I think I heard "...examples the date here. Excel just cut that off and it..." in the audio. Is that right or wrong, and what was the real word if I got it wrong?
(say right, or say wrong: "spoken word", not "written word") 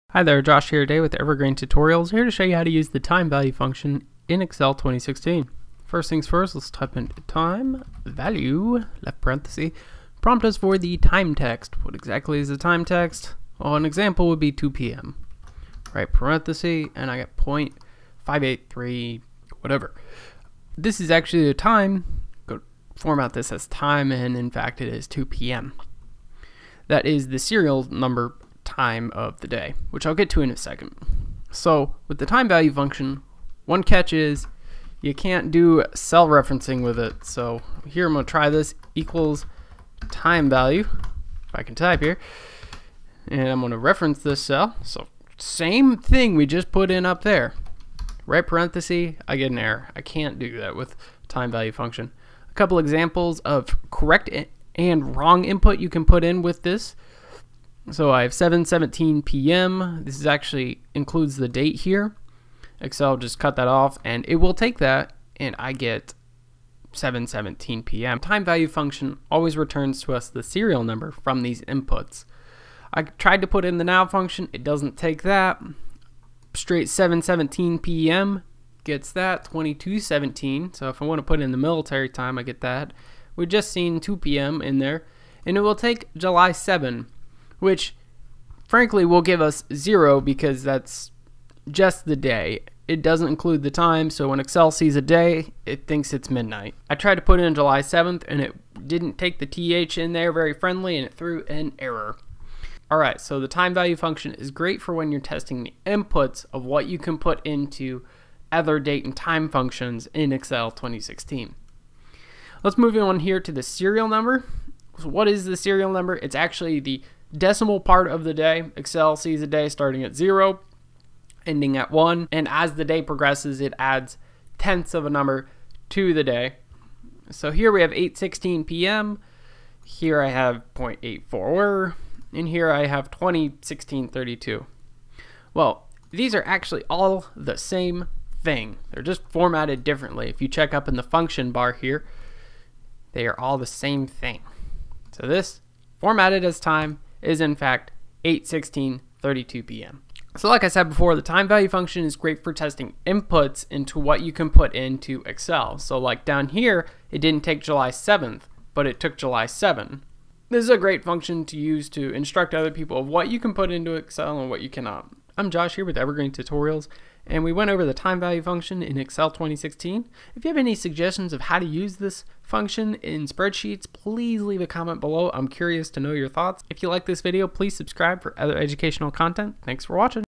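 wrong: "includes", not "examples".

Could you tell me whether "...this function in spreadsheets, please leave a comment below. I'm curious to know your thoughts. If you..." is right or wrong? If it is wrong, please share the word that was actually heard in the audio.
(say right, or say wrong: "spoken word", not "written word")
right.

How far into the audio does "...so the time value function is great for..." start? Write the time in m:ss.
1:43.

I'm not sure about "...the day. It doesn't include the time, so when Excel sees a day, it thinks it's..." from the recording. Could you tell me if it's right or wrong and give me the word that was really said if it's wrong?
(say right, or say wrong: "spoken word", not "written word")
right.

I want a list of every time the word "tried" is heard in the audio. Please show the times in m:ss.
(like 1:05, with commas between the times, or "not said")
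1:13, 1:36.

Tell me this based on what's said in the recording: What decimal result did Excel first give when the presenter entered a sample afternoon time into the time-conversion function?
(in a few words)
0.583.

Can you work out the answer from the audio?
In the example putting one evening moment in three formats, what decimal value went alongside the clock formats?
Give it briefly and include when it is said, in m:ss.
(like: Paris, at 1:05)
0.84, at 2:10.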